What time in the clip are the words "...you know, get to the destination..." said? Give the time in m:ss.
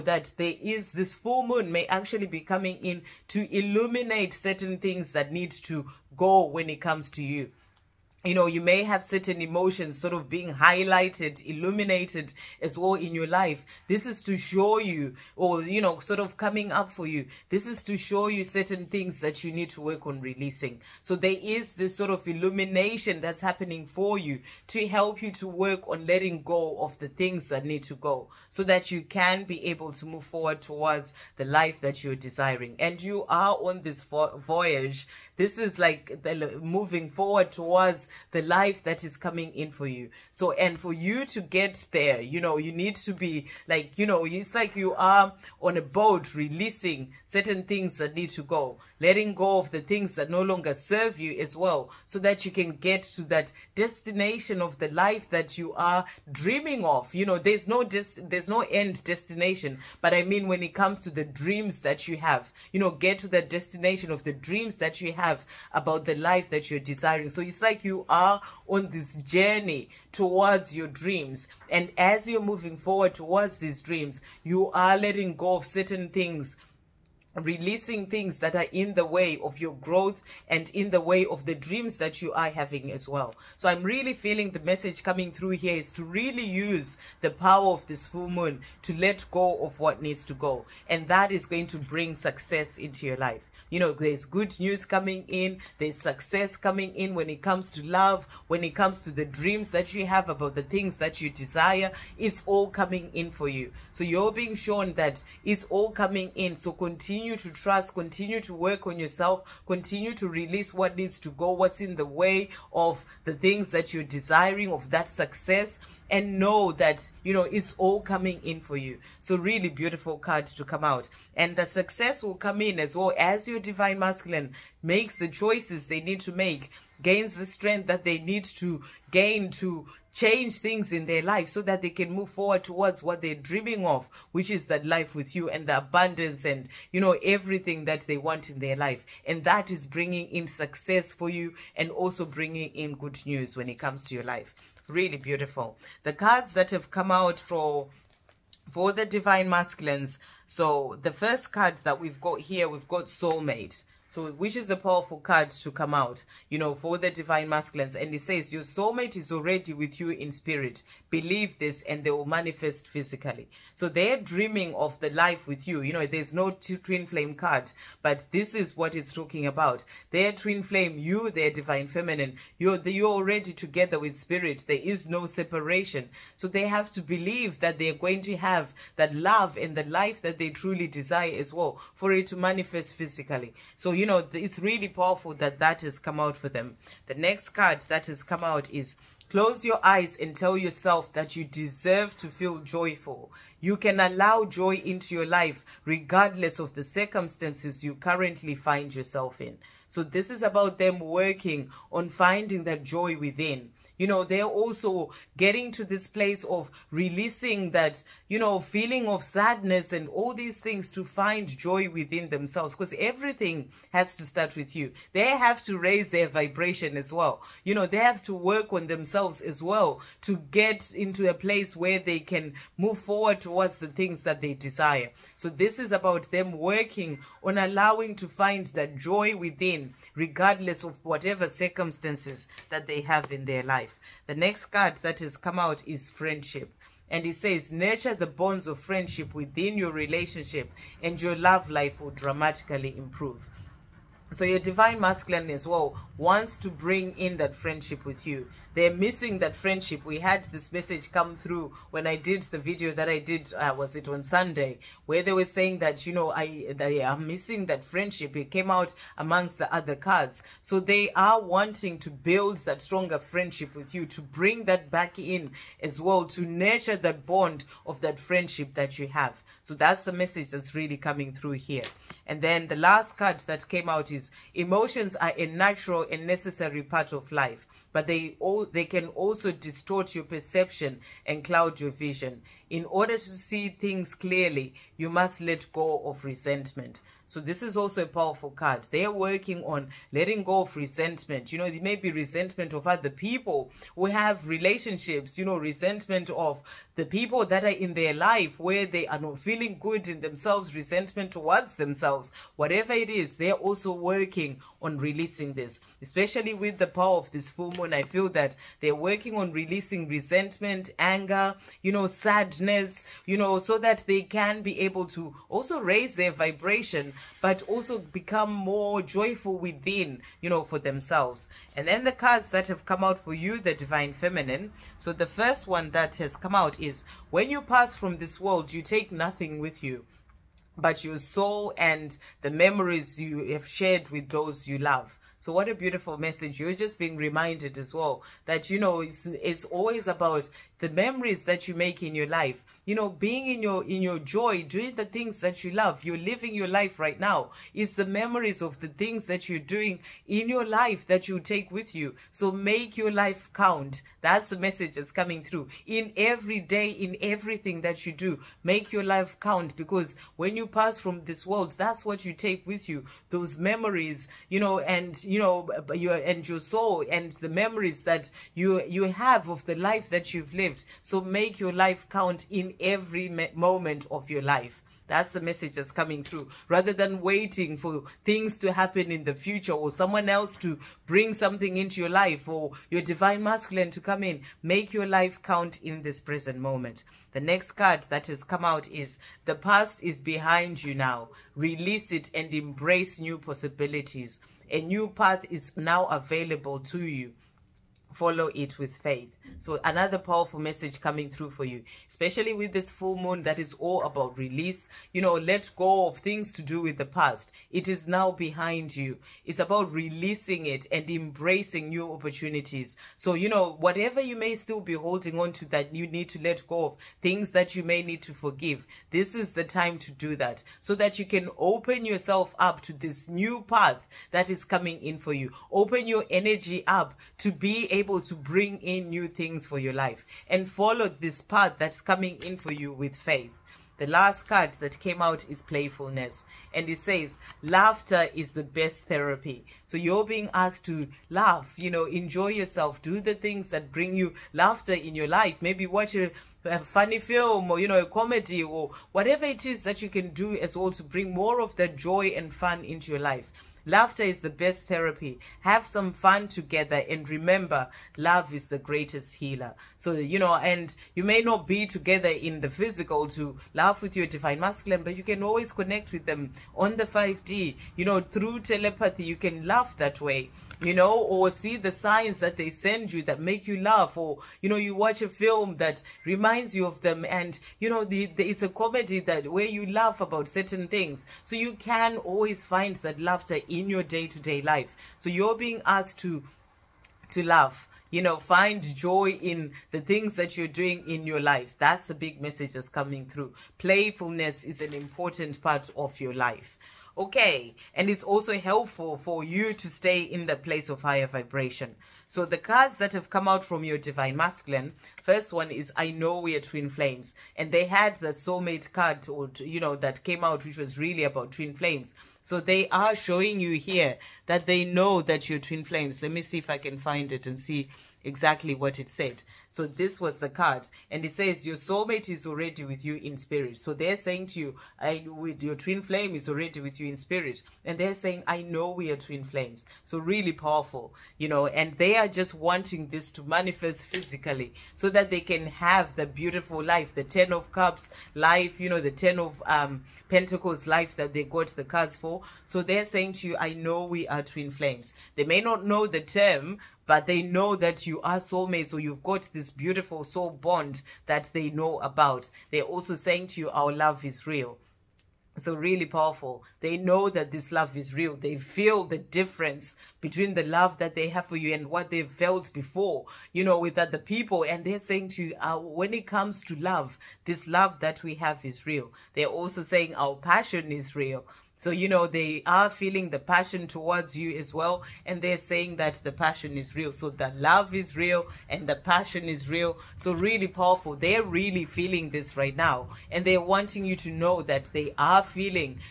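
1:02.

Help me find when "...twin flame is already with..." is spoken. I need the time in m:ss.
8:45.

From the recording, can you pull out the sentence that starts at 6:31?
Release it and embrace new possibilities.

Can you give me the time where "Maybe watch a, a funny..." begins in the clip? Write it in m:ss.
7:25.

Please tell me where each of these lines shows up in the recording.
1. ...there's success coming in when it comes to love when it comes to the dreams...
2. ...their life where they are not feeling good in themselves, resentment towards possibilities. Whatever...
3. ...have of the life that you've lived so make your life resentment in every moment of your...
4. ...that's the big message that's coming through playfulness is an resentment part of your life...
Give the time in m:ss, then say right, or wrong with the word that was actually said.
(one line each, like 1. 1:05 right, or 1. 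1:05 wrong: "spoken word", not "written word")
1. 1:35 right
2. 4:57 wrong: "themselves", not "possibilities"
3. 6:09 wrong: "count", not "resentment"
4. 8:11 wrong: "important", not "resentment".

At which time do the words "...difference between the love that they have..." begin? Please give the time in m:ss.
9:19.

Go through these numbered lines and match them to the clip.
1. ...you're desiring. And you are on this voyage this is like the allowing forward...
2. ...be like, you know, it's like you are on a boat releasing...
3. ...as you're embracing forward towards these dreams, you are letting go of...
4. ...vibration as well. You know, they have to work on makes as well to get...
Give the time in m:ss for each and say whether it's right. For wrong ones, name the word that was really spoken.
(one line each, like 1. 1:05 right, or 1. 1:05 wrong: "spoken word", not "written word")
1. 0:32 wrong: "moving", not "allowing"
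2. 0:43 right
3. 1:11 wrong: "moving", not "embracing"
4. 3:36 wrong: "themselves", not "makes".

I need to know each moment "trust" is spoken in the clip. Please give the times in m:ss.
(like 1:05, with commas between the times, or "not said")
1:47.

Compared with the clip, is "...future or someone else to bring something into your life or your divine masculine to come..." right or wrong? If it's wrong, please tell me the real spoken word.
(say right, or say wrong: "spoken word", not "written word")
right.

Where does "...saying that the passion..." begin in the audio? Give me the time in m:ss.
9:35.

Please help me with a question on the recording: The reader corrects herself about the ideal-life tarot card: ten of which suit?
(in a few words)
Pentacles.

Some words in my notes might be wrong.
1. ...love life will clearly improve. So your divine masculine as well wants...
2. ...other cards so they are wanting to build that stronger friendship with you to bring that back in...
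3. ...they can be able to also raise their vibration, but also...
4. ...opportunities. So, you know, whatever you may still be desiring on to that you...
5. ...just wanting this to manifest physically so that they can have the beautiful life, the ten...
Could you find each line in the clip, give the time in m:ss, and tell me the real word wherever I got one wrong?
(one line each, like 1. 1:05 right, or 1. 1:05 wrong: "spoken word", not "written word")
1. 4:01 wrong: "dramatically", not "clearly"
2. 4:19 right
3. 5:14 right
4. 6:52 wrong: "holding", not "desiring"
5. 8:52 right.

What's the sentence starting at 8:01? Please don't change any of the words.
So you can always find that laughter in your day-to-day -day life.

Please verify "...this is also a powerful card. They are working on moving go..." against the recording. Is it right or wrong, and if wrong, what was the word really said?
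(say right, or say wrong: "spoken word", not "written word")
wrong: "letting", not "moving".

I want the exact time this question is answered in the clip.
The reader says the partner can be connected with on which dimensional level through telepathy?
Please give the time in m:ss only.
7:47.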